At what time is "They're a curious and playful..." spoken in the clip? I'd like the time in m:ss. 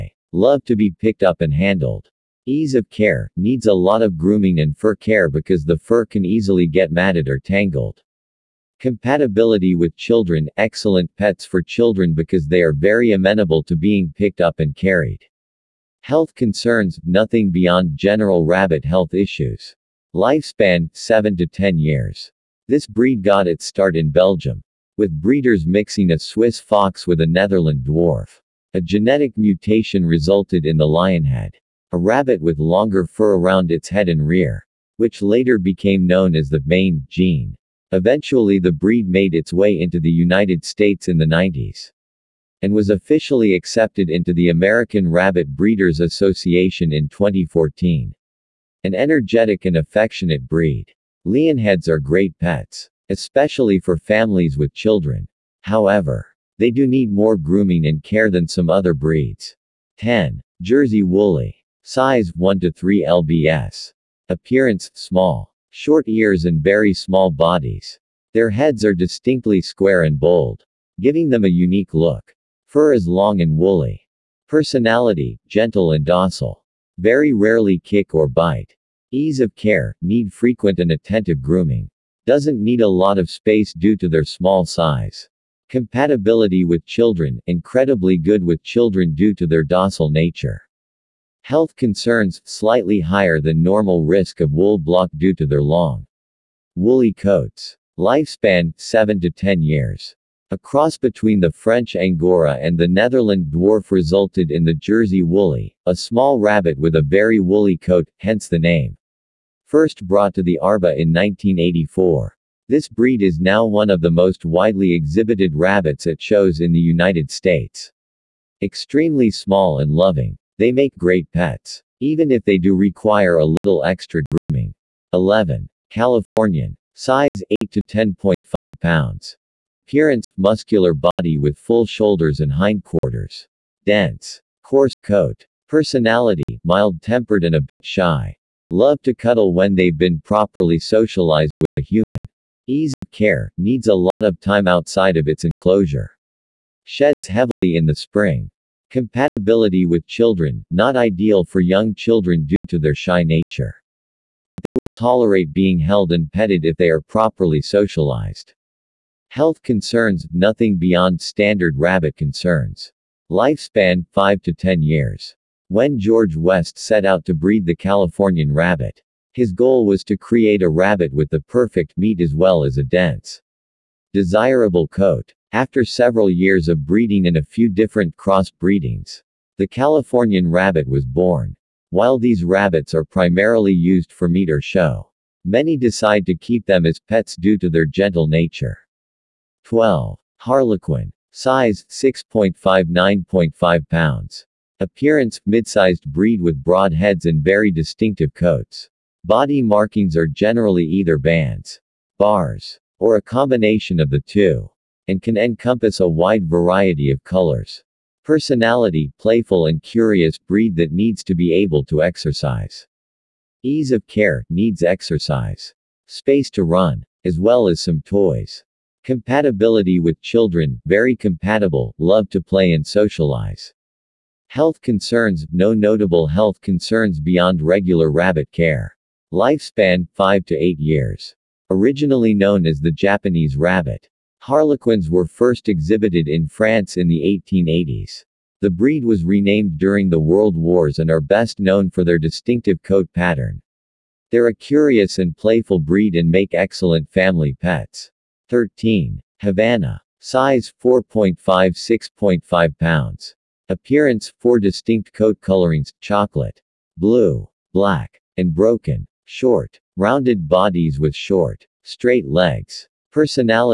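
4:04.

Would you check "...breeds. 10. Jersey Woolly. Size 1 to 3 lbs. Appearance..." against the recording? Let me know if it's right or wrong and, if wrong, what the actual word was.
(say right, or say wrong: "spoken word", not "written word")
right.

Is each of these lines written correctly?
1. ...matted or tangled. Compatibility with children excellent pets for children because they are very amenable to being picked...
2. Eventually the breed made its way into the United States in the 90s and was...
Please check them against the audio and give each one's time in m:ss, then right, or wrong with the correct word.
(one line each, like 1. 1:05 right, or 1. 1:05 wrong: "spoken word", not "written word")
1. 0:06 right
2. 0:37 right.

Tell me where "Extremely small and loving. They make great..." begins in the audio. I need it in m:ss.
1:58.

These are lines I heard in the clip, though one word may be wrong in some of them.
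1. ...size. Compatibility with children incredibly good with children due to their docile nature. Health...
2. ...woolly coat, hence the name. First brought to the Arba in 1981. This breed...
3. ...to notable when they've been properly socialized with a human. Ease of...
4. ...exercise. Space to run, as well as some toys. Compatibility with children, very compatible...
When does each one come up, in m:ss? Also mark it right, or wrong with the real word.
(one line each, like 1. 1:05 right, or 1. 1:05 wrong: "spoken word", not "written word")
1. 1:24 right
2. 1:47 wrong: "1984", not "1981"
3. 2:19 wrong: "cuddle", not "notable"
4. 3:34 right.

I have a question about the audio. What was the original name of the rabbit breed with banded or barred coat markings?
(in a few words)
Japanese rabbit.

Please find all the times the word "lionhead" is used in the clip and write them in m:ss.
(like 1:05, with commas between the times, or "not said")
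0:30, 0:51.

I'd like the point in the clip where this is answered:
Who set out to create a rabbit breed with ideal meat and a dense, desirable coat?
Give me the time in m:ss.
2:45.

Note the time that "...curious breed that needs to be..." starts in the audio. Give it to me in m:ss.
3:29.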